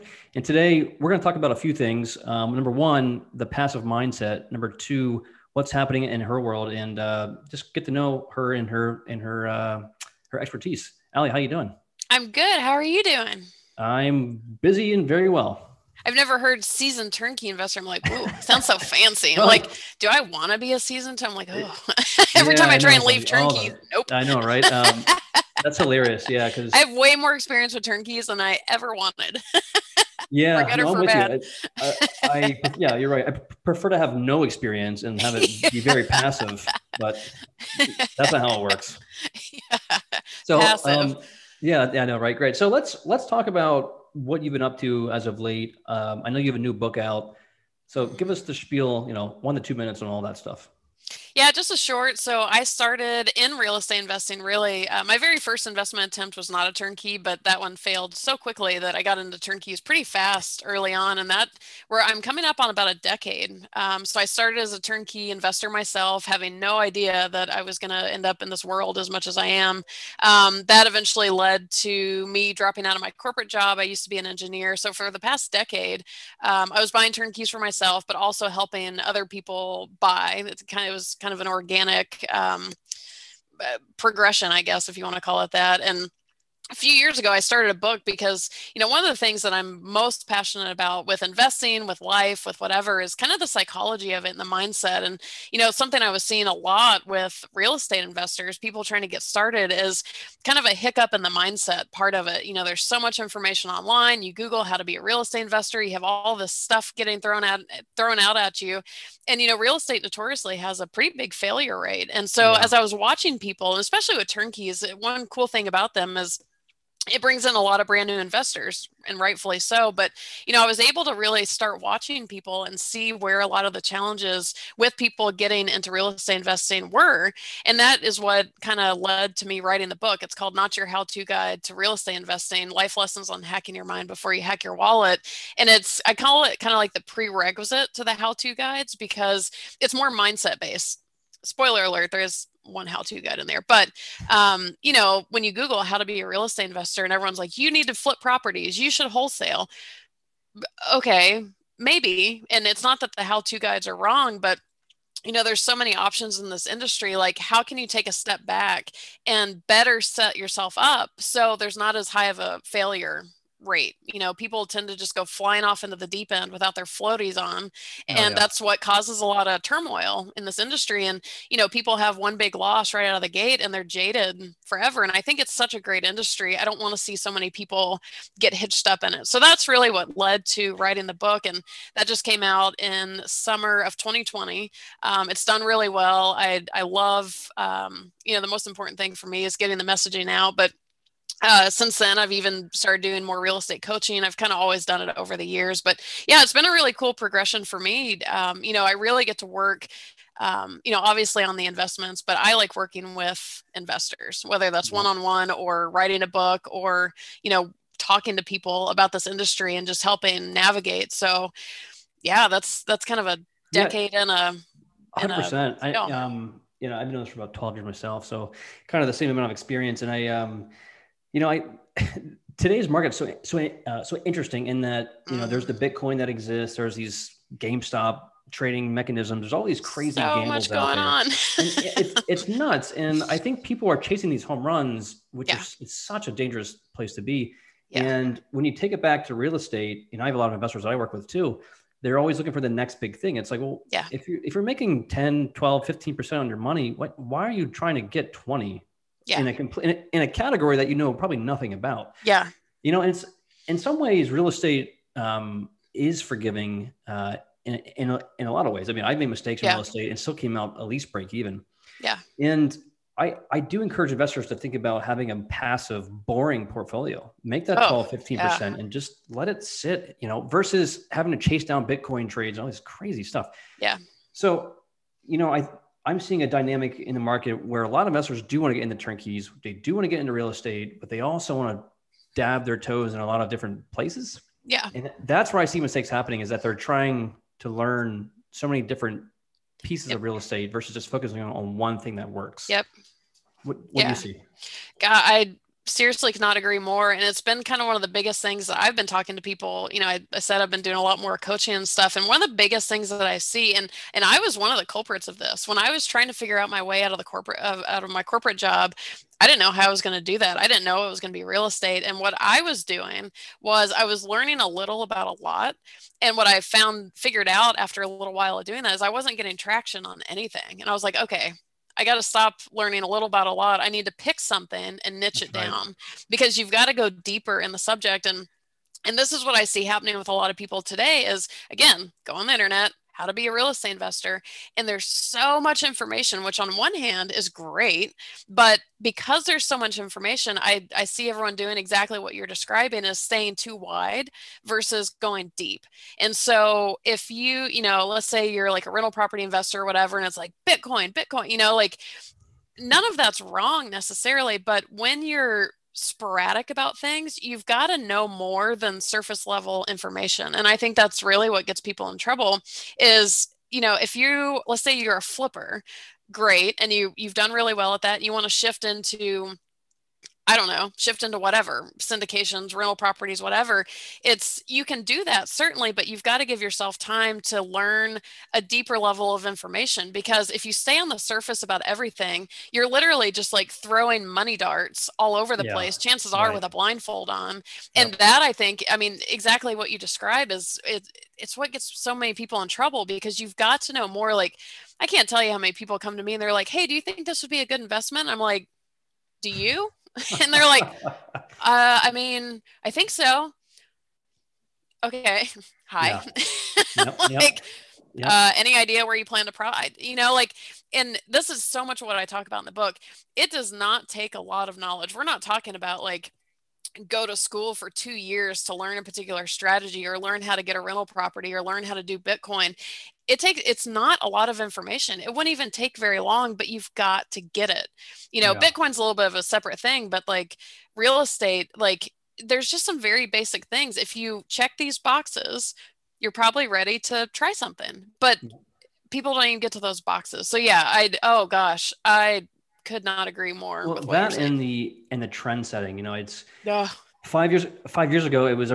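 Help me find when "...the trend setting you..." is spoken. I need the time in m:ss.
7:25.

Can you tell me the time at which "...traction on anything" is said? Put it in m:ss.
5:19.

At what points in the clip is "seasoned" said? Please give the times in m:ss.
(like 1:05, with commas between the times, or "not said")
0:16, 0:20.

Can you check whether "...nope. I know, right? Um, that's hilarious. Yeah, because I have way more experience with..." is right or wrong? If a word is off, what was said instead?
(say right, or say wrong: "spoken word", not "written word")
right.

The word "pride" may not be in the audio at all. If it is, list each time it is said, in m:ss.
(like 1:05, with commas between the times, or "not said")
6:49.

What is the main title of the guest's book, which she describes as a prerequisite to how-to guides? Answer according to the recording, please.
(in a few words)
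Not Your How To Guide to Real Estate Investing.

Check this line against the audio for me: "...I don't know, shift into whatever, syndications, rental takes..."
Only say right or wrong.
wrong.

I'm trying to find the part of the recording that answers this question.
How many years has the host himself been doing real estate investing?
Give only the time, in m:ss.
3:37.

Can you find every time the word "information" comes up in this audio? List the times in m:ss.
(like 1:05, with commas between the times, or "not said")
1:43, 5:35, 5:39, 5:59, 6:19, 7:04.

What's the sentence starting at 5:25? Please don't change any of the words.
down because you've got to go deeper in the subject.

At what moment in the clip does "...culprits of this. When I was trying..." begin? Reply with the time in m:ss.
5:04.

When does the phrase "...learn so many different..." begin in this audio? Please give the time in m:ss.
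4:47.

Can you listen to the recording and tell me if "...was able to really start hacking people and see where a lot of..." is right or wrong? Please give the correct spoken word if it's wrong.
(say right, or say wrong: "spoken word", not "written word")
wrong: "watching", not "hacking".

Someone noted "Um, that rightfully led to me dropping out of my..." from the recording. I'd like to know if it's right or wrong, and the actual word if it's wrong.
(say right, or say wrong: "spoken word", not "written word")
wrong: "eventually", not "rightfully".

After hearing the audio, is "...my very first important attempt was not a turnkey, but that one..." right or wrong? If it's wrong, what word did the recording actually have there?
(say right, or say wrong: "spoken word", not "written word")
wrong: "investment", not "important".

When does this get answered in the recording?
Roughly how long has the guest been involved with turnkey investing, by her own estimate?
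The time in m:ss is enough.
1:02.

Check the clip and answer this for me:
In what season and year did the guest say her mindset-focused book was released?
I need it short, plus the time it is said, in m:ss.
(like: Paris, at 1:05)
summer of 2020, at 3:03.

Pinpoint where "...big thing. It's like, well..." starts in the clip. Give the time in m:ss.
4:03.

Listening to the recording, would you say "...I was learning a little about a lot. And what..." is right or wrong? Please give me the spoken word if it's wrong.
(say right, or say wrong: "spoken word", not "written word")
right.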